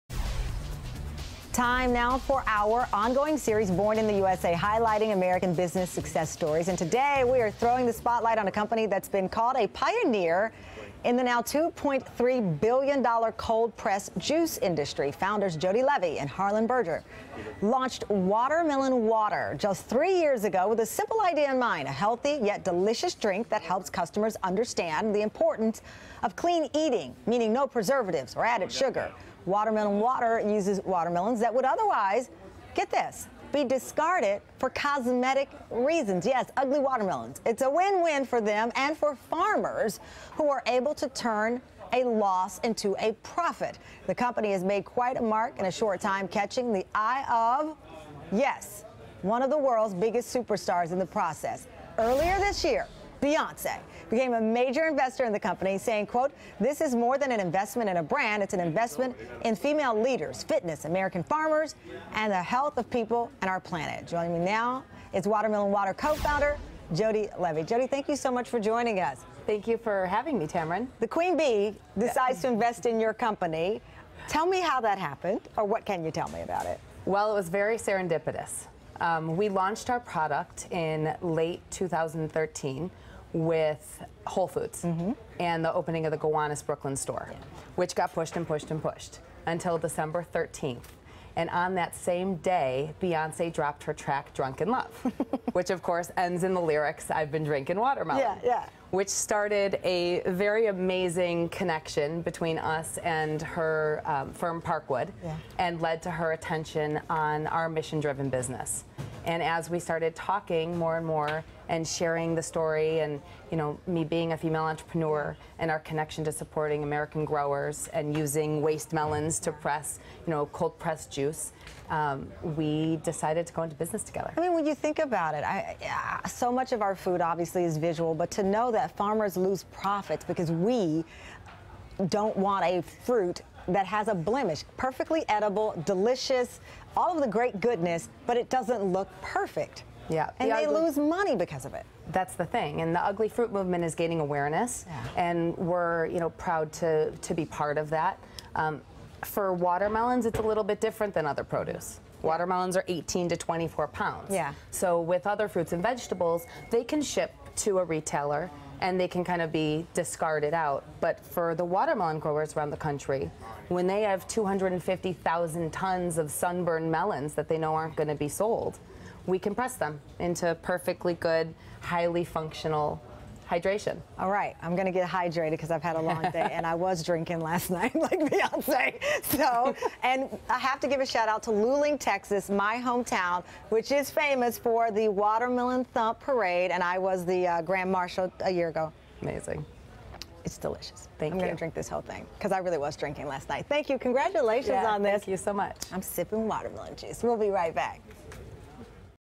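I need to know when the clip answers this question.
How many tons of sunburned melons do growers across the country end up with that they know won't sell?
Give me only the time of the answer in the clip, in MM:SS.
02:44.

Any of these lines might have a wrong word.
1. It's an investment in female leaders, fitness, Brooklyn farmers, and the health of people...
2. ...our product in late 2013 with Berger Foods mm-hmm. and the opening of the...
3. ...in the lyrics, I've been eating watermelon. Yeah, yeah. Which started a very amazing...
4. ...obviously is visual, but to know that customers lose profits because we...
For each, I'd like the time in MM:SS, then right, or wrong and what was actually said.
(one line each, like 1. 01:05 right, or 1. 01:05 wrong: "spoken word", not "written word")
1. 00:58 wrong: "American", not "Brooklyn"
2. 01:19 wrong: "Whole", not "Berger"
3. 01:36 wrong: "drinking", not "eating"
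4. 02:07 wrong: "farmers", not "customers".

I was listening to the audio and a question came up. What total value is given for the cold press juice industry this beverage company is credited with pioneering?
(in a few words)
$2.3 billion.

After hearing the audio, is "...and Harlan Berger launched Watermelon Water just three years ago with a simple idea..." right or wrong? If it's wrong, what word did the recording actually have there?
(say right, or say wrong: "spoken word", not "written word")
right.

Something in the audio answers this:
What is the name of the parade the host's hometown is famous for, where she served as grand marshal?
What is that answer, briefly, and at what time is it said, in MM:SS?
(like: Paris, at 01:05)
Watermelon Thump Parade, at 03:05.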